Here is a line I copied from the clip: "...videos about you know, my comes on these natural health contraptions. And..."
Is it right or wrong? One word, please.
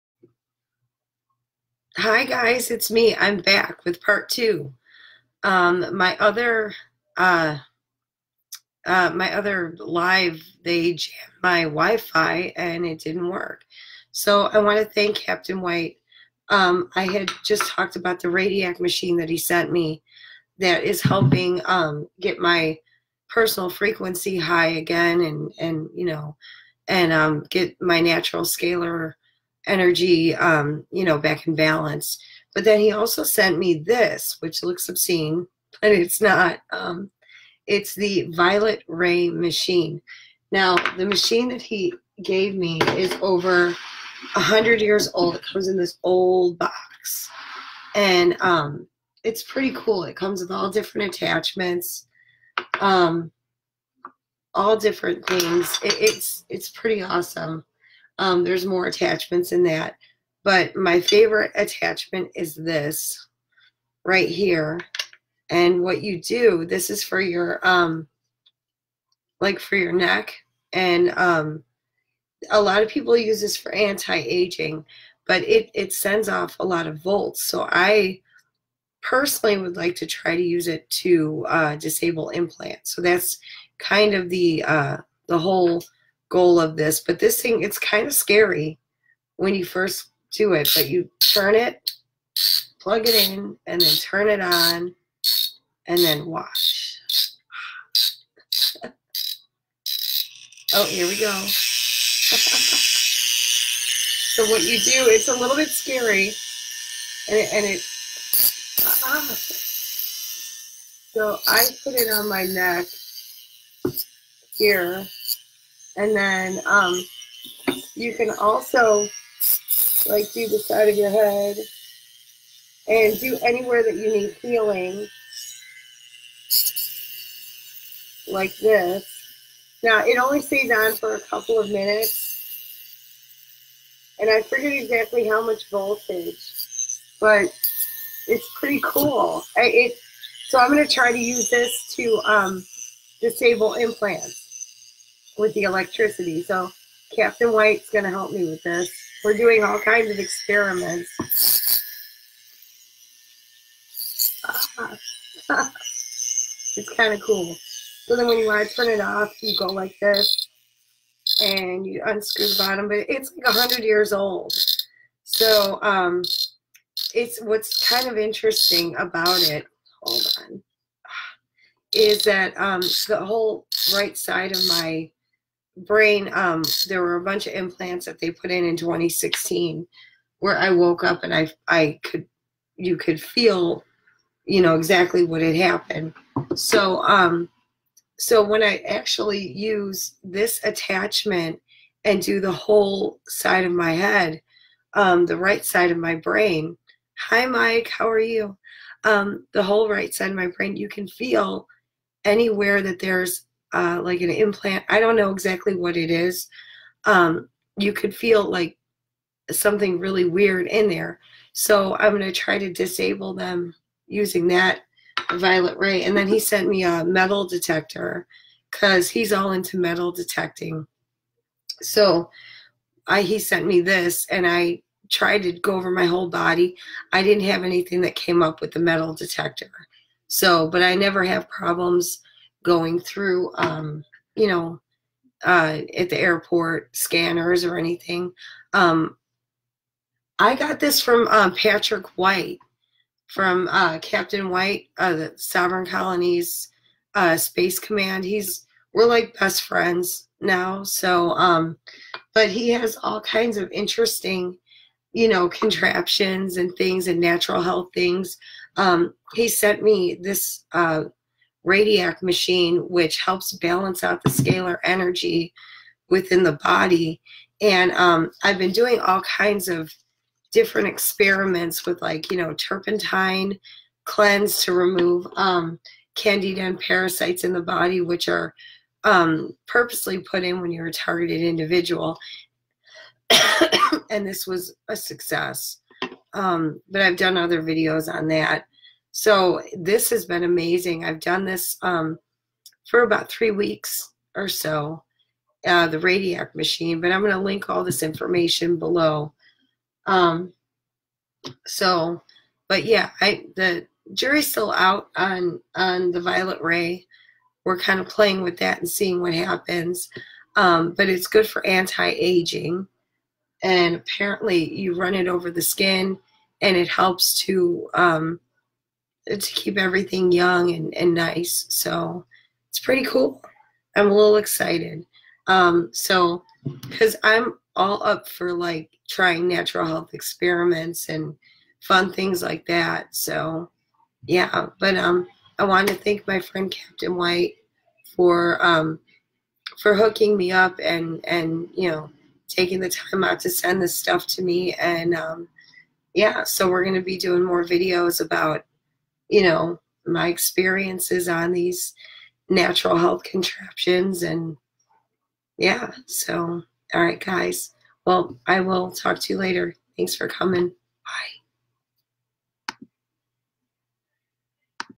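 wrong.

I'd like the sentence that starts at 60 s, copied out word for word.
But my favorite attachment is this right here.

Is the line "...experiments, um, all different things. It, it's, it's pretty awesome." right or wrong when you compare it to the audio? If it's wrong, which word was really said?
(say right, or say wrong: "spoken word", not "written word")
wrong: "attachments", not "experiments".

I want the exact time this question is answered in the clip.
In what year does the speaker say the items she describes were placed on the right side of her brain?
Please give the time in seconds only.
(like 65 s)
178 s.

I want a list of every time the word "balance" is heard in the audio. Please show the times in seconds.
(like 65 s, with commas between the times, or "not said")
31 s, 263 s.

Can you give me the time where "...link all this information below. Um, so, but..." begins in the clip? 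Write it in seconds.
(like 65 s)
297 s.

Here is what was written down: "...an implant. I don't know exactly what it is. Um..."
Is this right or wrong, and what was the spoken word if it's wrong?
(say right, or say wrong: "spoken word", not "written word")
right.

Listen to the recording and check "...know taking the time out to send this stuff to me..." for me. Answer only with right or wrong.
right.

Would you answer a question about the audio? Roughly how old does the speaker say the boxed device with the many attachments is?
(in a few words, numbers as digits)
Over 100 years.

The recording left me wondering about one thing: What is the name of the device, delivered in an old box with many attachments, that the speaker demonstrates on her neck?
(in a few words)
Violet Ray machine.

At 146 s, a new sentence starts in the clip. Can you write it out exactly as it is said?
So Captain White's going to help me with this.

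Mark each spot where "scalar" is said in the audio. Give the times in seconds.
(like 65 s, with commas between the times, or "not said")
28 s, 264 s.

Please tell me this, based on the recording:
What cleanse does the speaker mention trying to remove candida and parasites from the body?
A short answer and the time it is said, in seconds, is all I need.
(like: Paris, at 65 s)
Turpentine cleanse, at 272 s.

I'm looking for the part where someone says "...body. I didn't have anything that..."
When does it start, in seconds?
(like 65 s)
226 s.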